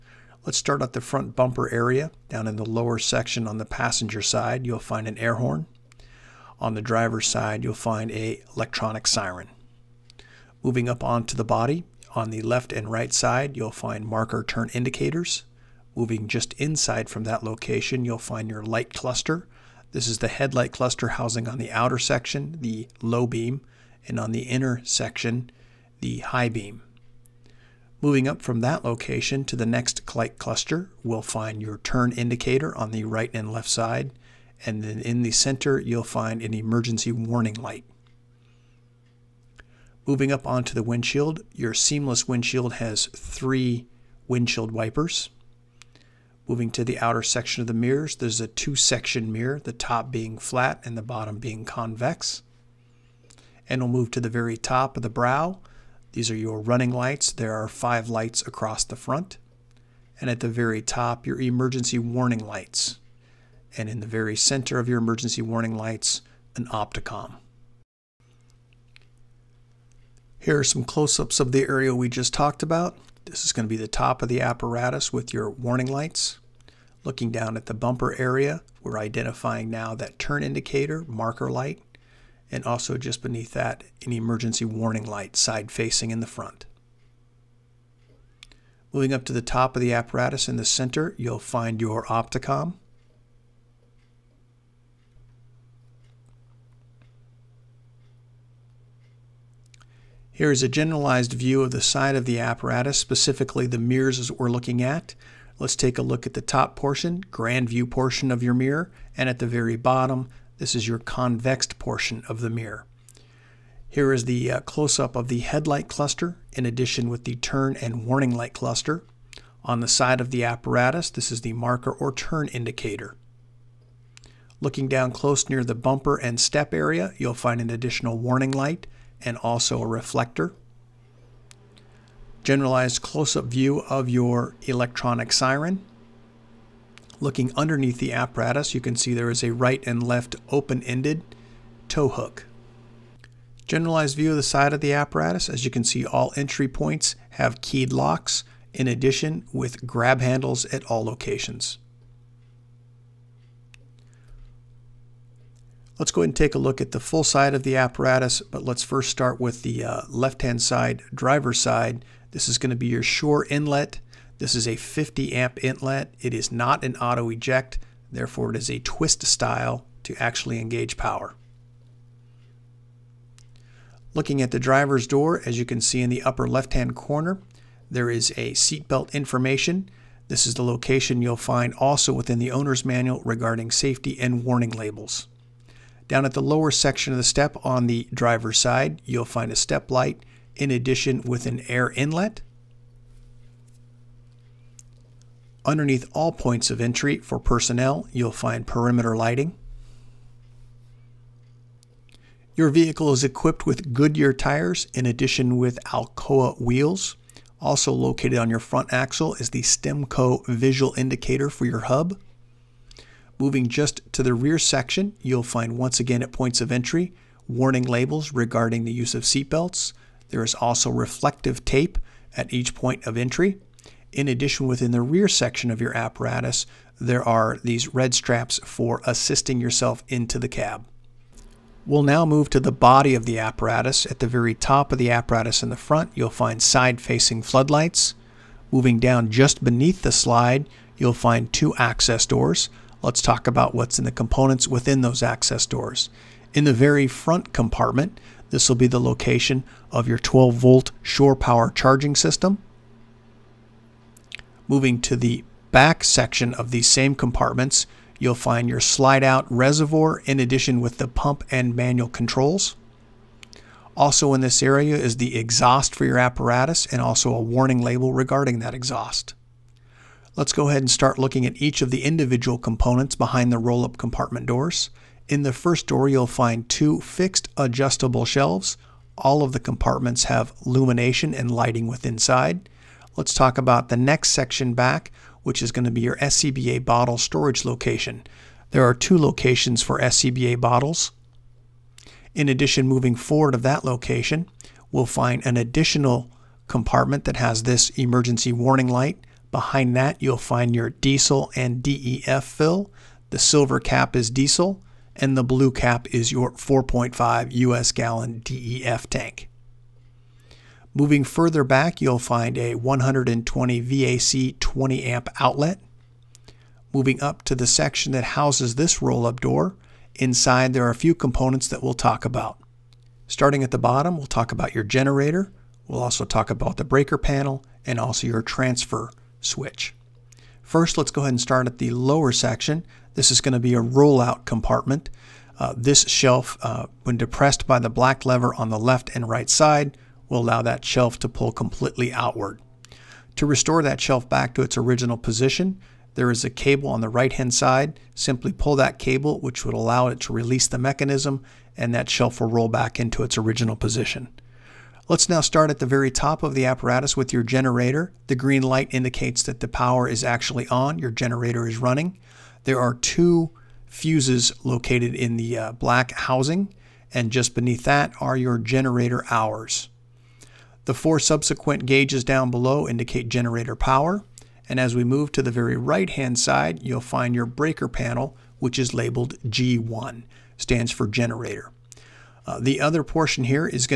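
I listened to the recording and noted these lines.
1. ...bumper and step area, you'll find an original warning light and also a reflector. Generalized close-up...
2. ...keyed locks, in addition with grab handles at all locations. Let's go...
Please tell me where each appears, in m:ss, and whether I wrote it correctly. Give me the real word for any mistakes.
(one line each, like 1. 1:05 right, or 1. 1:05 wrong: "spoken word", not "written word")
1. 2:05 wrong: "additional", not "original"
2. 2:27 right.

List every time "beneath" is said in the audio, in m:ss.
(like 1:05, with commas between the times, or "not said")
1:23, 3:59, 6:07.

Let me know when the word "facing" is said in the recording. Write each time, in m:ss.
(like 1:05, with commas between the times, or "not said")
1:25, 3:56.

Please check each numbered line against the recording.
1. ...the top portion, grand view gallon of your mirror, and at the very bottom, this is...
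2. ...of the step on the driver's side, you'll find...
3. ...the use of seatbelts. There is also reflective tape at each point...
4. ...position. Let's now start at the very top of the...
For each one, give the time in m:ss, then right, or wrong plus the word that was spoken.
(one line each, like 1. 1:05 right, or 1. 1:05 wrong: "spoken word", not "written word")
1. 1:46 wrong: "portion", not "gallon"
2. 3:07 right
3. 3:38 right
4. 5:53 right.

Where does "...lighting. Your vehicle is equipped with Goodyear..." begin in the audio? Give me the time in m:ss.
3:19.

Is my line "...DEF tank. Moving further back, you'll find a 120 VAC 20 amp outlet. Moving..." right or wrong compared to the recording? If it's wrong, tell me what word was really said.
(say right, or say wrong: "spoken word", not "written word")
right.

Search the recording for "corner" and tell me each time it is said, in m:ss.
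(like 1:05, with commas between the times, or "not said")
2:56.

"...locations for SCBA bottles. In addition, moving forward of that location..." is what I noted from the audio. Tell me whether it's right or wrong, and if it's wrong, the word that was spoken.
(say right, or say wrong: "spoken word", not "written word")
right.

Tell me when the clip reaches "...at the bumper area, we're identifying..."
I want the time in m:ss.
1:17.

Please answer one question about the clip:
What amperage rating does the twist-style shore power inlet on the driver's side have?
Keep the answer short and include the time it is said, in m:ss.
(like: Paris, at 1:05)
50 amp, at 2:44.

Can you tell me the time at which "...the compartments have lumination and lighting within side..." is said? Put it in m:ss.
4:39.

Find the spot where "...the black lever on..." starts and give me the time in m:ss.
5:37.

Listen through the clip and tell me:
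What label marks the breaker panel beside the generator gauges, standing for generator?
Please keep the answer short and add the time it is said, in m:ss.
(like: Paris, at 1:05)
G1, at 6:19.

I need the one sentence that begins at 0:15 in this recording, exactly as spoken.
Moving just inside from that location, you'll find your light cluster.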